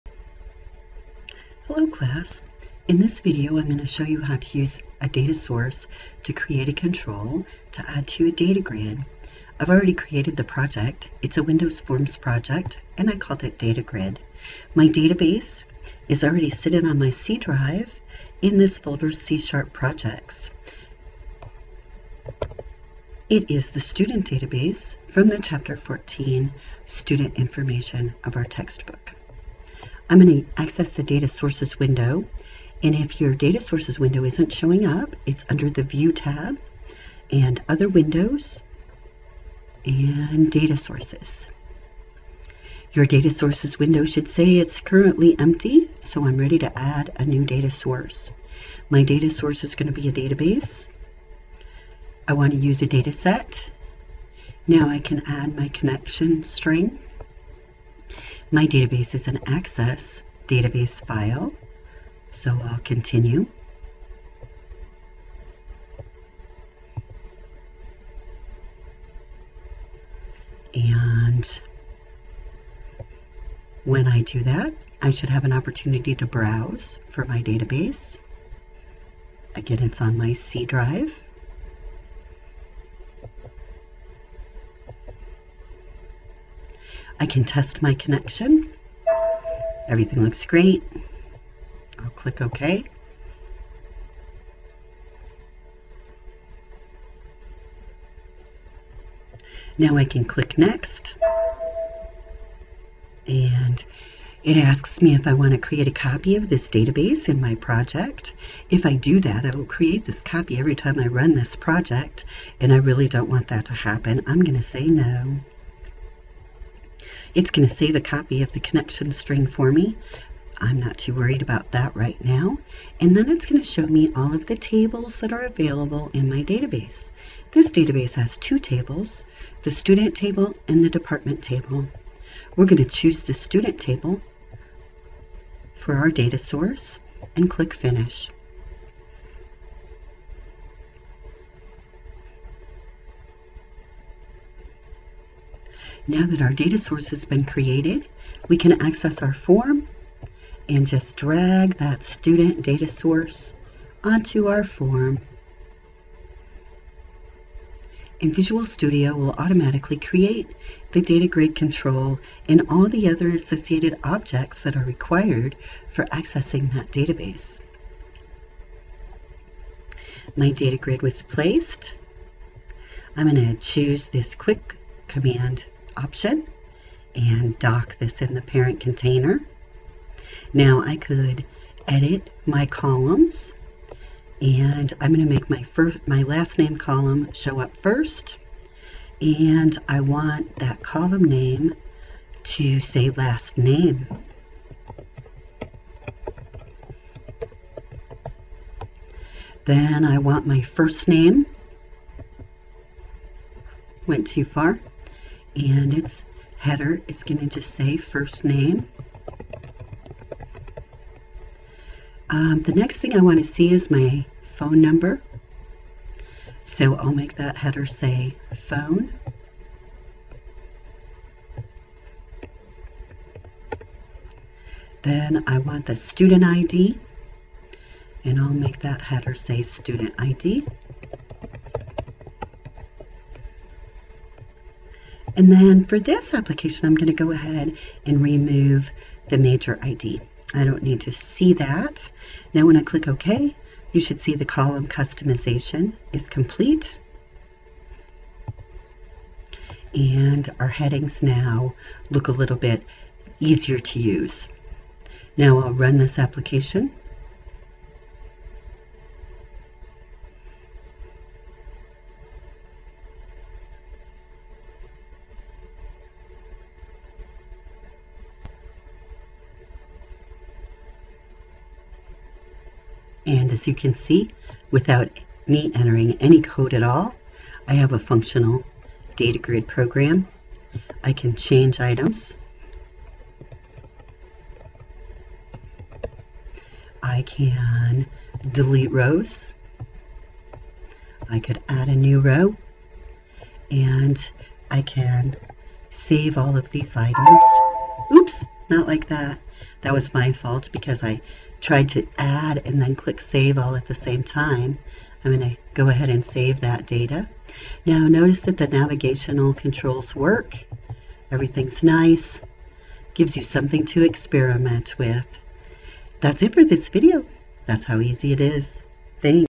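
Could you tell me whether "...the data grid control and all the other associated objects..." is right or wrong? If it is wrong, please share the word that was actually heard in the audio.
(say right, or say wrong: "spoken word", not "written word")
right.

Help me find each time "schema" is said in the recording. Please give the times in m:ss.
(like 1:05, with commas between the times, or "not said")
not said.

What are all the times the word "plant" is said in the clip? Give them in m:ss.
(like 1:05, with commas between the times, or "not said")
not said.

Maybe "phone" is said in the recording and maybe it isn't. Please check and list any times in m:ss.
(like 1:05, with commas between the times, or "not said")
3:34, 3:38.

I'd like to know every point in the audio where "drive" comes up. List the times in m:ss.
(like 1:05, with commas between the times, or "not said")
0:17, 1:20.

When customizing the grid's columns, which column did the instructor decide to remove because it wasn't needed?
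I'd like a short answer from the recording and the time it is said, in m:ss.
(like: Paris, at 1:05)
major ID, at 3:59.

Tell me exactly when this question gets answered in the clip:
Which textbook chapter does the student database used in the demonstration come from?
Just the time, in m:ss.
0:25.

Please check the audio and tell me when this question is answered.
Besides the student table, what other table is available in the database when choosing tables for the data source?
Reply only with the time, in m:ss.
2:10.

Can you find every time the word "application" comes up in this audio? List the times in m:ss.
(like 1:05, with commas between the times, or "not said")
3:56, 4:16.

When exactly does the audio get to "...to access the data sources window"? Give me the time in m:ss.
0:30.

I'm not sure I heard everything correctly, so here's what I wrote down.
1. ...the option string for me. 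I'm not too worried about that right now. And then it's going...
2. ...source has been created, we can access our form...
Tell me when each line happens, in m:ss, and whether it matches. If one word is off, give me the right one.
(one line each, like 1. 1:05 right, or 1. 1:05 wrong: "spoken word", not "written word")
1. 1:58 wrong: "connection", not "option"
2. 2:26 right.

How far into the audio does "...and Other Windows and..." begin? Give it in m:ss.
0:37.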